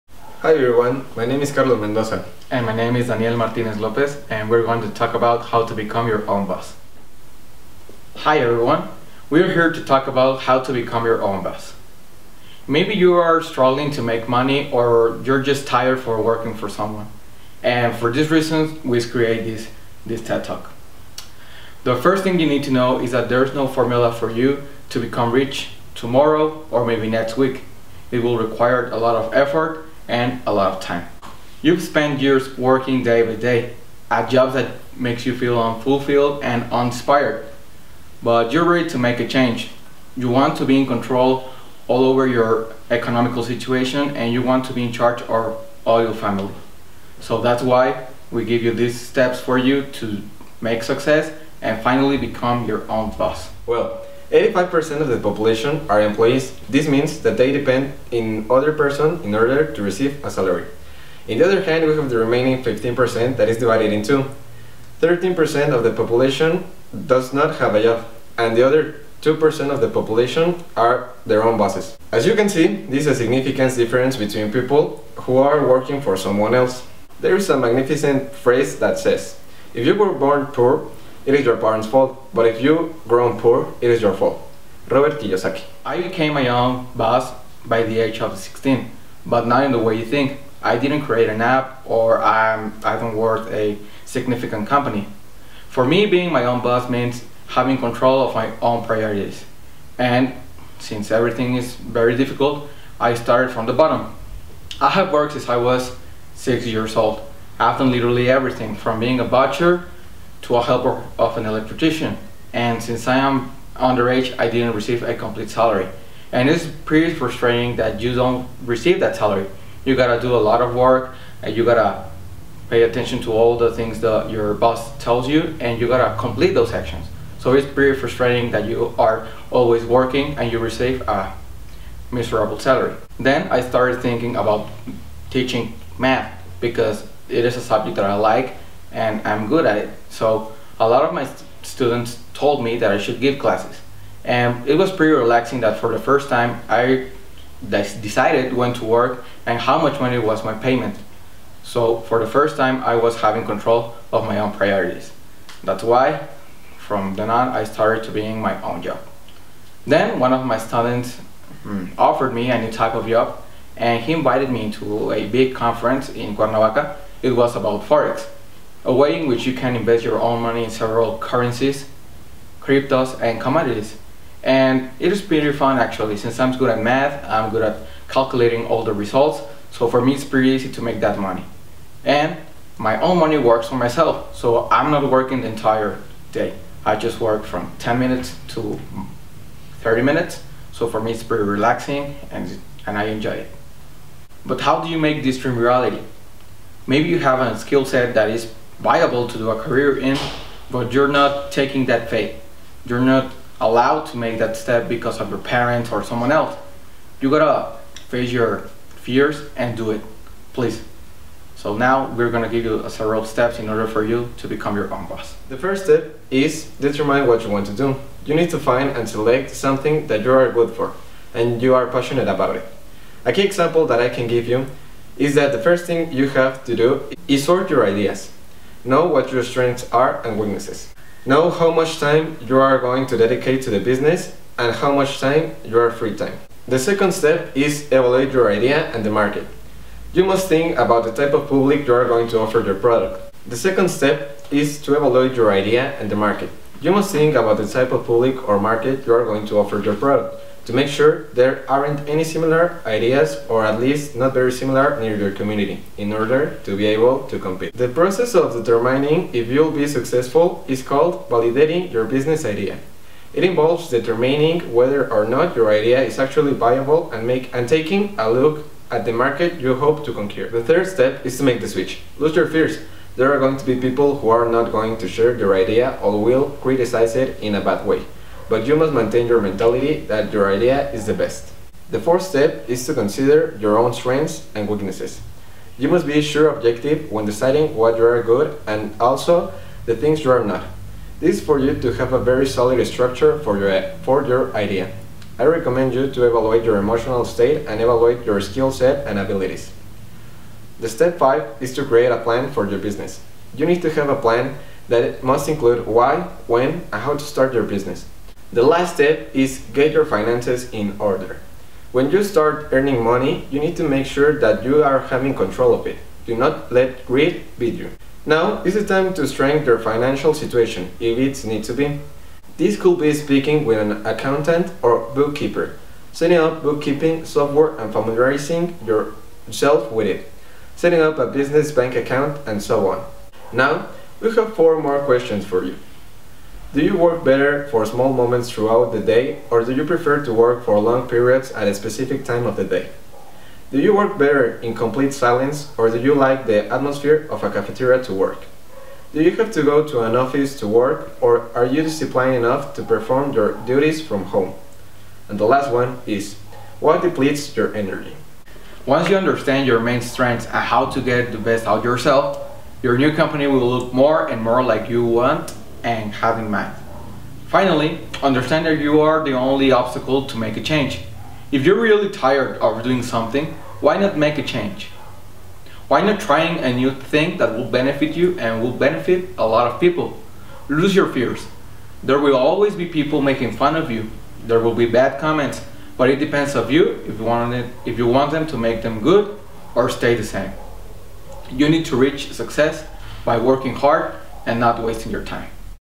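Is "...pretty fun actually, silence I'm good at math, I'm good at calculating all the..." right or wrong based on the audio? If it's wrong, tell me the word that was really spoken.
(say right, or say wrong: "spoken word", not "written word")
wrong: "since", not "silence".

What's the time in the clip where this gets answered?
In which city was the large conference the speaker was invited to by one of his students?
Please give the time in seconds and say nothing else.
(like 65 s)
166 s.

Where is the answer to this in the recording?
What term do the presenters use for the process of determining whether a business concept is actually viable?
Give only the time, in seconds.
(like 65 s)
261 s.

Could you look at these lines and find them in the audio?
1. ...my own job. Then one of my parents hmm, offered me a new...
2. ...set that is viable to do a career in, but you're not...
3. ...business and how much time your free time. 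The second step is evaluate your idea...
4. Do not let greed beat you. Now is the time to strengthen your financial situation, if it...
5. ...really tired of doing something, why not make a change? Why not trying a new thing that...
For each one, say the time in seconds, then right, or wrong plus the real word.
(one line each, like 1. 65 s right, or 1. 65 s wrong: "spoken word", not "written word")
1. 158 s wrong: "students", not "parents"
2. 197 s right
3. 233 s right
4. 316 s right
5. 371 s right.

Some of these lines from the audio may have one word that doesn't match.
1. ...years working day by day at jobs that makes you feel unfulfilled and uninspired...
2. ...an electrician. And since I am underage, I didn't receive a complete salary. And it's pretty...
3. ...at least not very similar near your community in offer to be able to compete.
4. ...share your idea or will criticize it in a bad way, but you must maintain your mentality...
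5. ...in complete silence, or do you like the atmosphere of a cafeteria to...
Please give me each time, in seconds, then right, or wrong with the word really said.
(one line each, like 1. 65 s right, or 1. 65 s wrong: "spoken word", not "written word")
1. 32 s right
2. 111 s right
3. 253 s wrong: "order", not "offer"
4. 275 s right
5. 344 s right.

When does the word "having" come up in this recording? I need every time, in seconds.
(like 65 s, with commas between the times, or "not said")
97 s, 153 s, 315 s.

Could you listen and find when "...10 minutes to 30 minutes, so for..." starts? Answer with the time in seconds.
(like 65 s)
187 s.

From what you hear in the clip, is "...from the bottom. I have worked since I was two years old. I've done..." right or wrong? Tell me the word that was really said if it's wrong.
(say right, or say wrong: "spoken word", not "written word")
wrong: "six", not "two".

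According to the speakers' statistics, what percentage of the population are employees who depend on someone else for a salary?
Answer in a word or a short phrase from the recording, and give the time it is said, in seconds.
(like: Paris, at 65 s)
85%, at 54 s.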